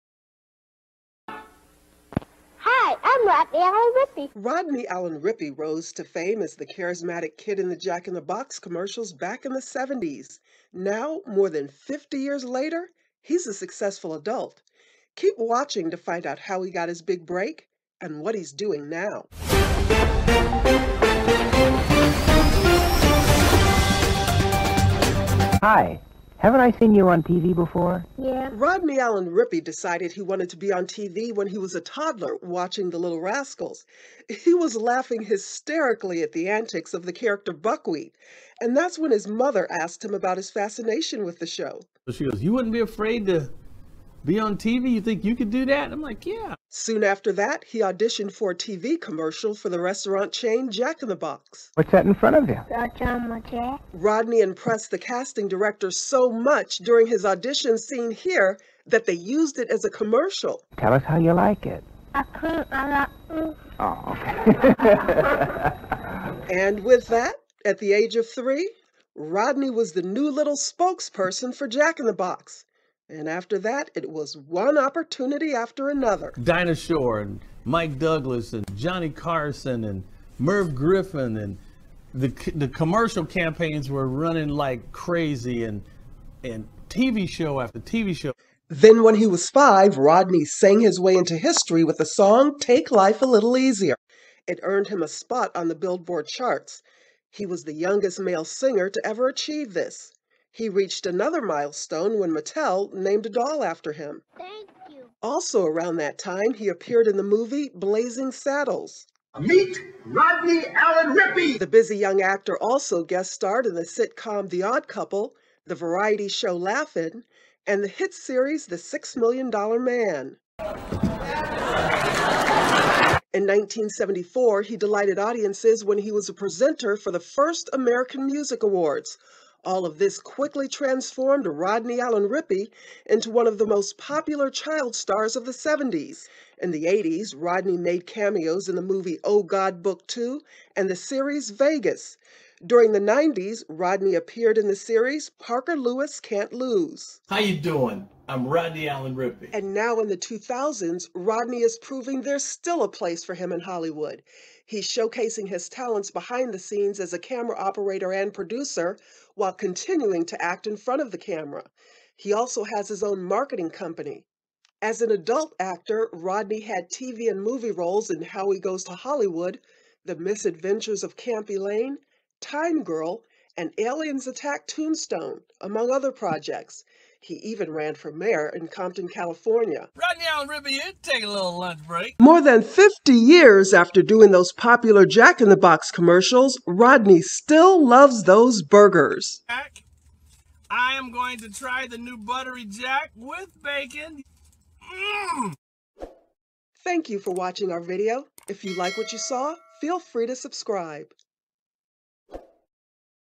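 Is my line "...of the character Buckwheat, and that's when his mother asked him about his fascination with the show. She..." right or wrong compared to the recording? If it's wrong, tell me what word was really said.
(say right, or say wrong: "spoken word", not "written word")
right.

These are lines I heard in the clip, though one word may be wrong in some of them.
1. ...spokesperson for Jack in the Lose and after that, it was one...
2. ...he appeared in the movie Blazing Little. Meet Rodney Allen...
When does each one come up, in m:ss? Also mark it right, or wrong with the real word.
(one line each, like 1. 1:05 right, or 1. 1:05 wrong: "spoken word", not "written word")
1. 1:10 wrong: "Box", not "Lose"
2. 1:46 wrong: "Saddles", not "Little".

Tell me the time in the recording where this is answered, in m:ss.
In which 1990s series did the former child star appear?
2:25.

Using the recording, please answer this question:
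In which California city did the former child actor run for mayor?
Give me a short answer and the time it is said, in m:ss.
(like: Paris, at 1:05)
Compton, at 2:58.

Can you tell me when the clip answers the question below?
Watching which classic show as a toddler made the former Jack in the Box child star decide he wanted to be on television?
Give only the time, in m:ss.
0:32.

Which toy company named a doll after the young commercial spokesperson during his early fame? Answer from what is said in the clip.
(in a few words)
Mattel.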